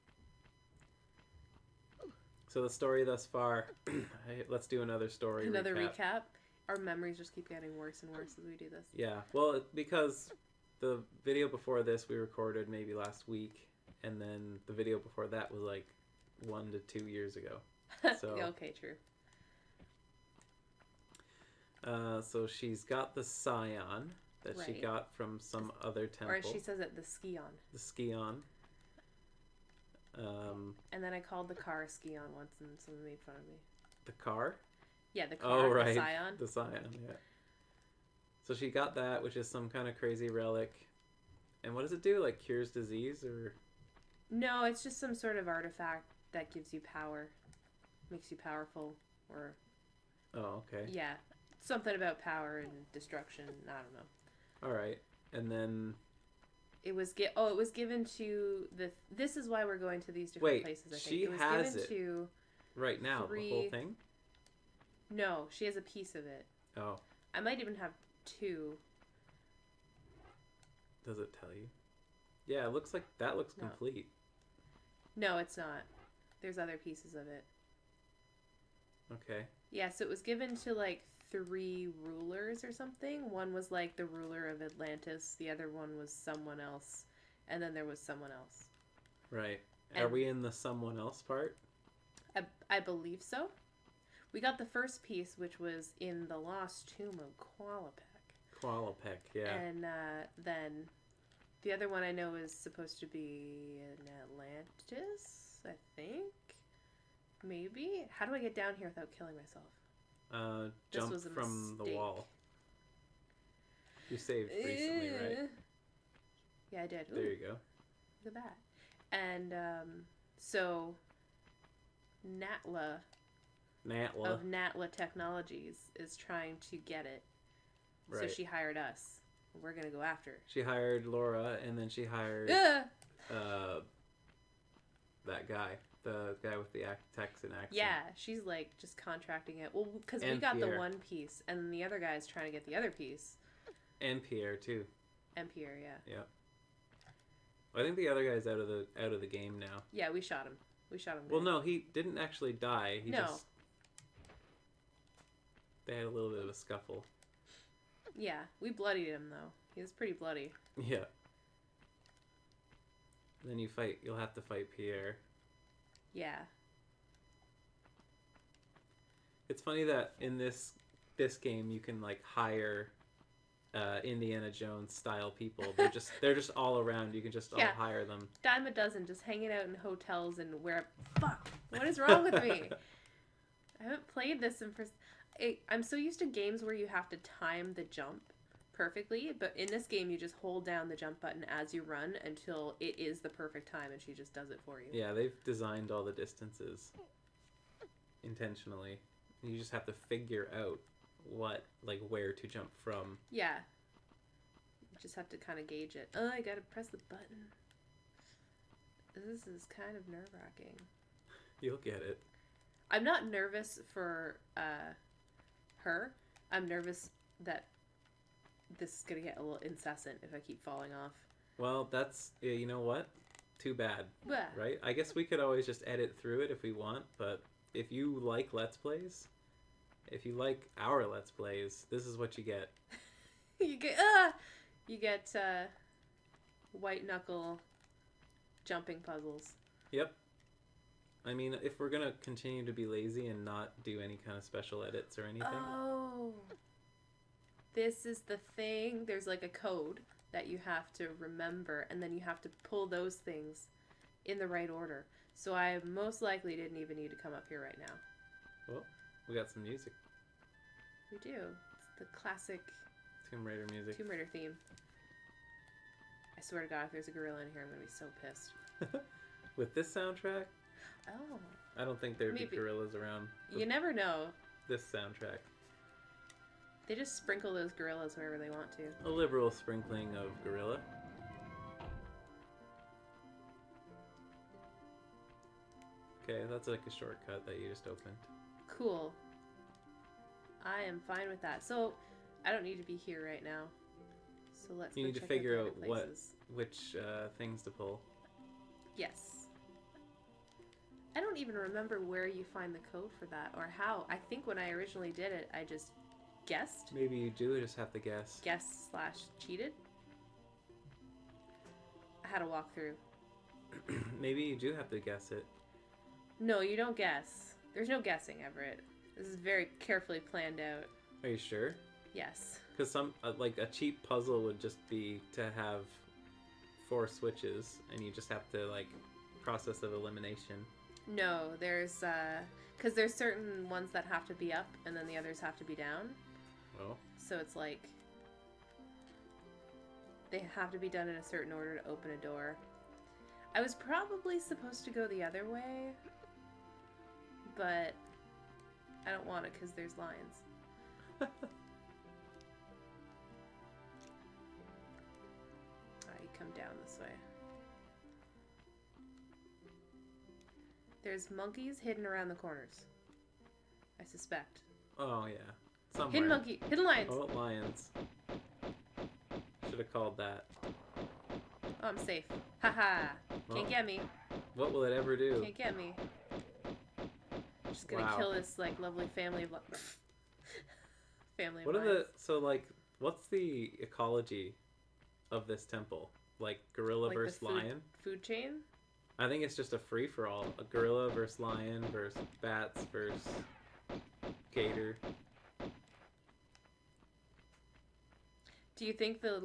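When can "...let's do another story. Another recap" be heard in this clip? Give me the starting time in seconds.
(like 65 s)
4 s.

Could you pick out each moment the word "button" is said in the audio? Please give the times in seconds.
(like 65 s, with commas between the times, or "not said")
191 s, 207 s.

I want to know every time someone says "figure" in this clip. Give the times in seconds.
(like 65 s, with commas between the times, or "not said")
200 s, 295 s.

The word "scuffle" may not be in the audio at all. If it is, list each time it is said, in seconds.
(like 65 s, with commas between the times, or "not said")
156 s.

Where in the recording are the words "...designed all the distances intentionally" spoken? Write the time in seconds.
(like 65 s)
195 s.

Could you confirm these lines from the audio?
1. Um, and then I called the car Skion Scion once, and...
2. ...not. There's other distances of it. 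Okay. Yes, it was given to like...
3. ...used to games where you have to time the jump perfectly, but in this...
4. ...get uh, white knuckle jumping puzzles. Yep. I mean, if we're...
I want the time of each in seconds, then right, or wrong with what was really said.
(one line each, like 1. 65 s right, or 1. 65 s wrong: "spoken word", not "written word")
1. 30 s right
2. 75 s wrong: "pieces", not "distances"
3. 185 s right
4. 234 s right.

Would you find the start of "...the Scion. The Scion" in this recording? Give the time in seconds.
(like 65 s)
35 s.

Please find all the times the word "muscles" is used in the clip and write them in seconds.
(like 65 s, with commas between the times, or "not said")
not said.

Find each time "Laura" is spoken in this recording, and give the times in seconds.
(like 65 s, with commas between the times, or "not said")
131 s.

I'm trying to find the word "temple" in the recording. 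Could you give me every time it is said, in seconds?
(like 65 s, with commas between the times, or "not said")
26 s, 385 s.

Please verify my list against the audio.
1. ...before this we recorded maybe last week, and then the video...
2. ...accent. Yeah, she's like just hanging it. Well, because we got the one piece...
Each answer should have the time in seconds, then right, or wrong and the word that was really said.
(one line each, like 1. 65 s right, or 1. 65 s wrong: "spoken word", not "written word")
1. 11 s right
2. 137 s wrong: "contracting", not "hanging".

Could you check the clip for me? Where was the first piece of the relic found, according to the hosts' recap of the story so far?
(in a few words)
Lost tomb of Qualopec.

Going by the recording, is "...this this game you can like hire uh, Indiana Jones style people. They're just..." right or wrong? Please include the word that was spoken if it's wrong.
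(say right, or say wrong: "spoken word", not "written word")
right.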